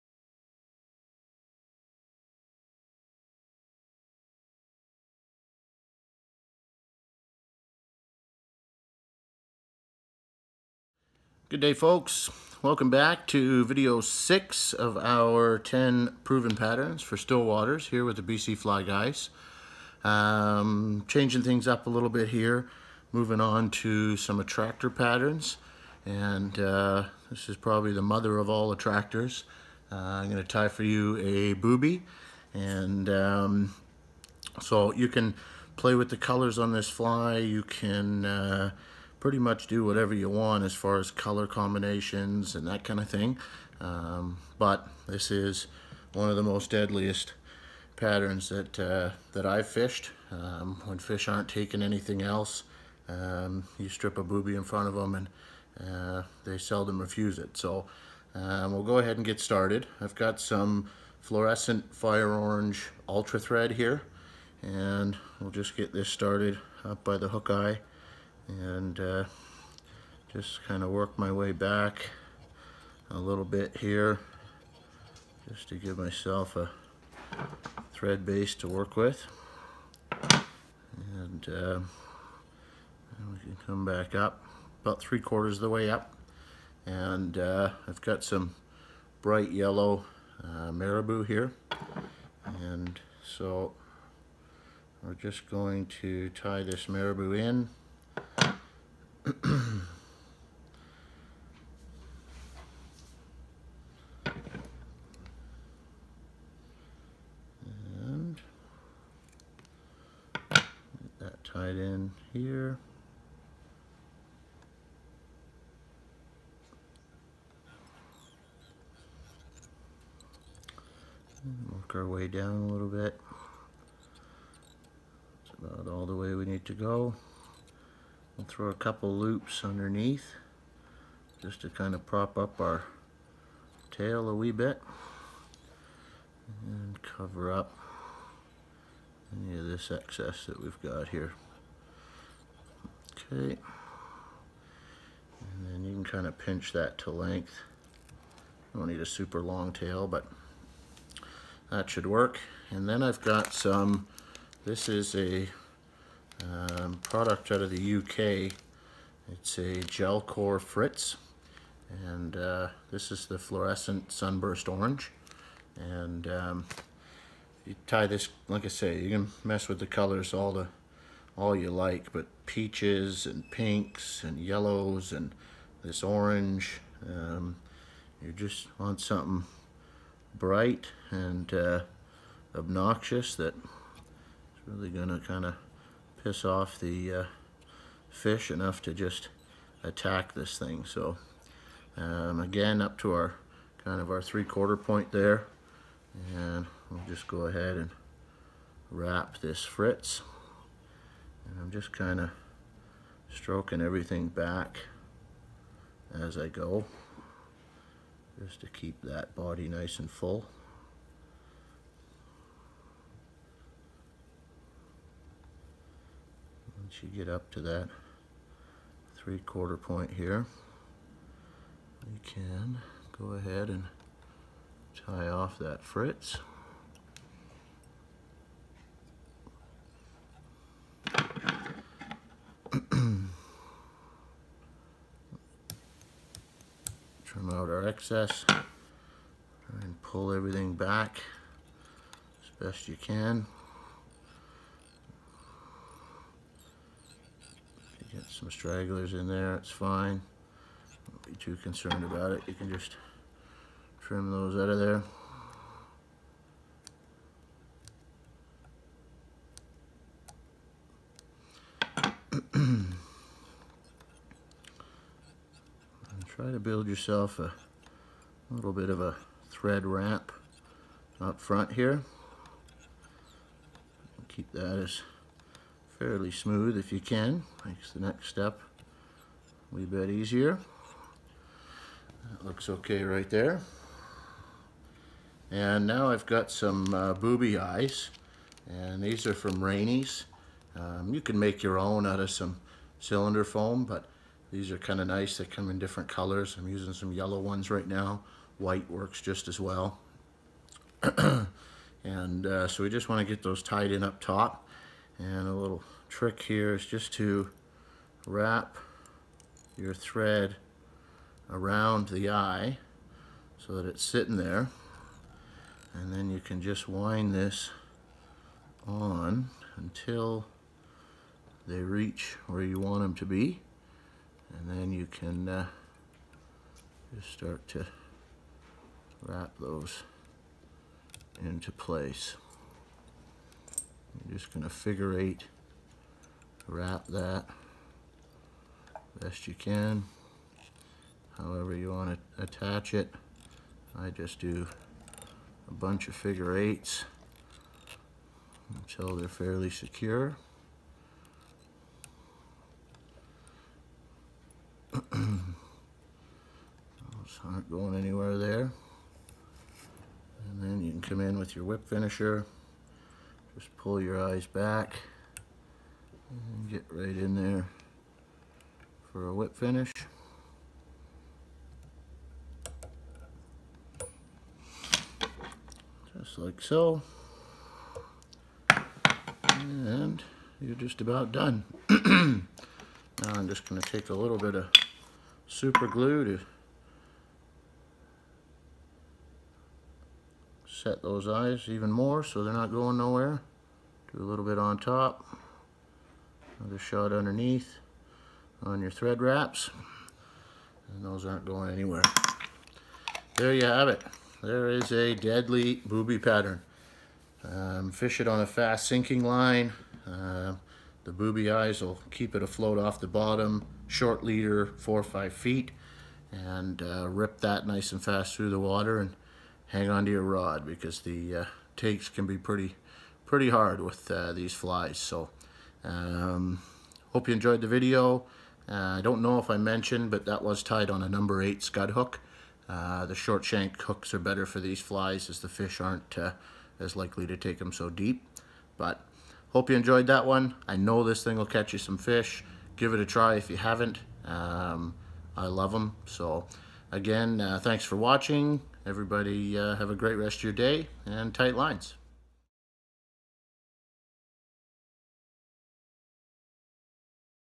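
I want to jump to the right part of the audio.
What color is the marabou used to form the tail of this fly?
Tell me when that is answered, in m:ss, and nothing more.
1:29.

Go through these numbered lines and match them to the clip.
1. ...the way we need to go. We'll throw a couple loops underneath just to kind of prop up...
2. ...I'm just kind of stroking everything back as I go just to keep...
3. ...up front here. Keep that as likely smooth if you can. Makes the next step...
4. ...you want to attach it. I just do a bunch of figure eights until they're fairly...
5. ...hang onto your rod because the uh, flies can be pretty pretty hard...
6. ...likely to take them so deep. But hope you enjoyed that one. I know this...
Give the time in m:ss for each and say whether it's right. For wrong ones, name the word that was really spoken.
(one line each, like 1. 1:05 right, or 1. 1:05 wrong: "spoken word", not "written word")
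1. 2:06 right
2. 3:21 right
3. 4:31 wrong: "fairly", not "likely"
4. 5:41 right
5. 6:59 wrong: "takes", not "flies"
6. 7:16 right.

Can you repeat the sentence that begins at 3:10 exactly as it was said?
So um, again, up to our kind of our three quarter point there.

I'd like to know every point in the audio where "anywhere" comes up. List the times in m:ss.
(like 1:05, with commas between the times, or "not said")
5:57, 6:41.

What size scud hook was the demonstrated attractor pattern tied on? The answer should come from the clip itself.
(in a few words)
Number 8.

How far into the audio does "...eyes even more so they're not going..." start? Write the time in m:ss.
6:31.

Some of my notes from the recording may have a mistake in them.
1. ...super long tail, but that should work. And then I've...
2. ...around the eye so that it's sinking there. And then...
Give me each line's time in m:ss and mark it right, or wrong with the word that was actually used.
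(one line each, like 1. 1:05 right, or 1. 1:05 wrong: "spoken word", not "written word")
1. 2:29 right
2. 5:11 wrong: "sitting", not "sinking".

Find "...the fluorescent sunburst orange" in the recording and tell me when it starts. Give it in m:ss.
2:43.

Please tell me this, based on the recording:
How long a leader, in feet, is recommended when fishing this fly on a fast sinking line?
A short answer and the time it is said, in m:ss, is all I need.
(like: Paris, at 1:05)
4 or 5 feet, at 6:54.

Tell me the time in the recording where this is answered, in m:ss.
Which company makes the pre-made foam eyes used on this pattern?
4:49.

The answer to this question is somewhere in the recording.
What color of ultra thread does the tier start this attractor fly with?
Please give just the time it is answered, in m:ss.
1:01.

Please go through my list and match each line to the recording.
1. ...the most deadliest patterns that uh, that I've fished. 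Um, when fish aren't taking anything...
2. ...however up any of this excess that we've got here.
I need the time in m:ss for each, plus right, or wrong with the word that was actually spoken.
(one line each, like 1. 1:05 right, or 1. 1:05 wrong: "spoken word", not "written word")
1. 0:46 right
2. 2:17 wrong: "cover", not "however".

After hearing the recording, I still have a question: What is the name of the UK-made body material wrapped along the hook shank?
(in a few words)
Gelcore Fritz.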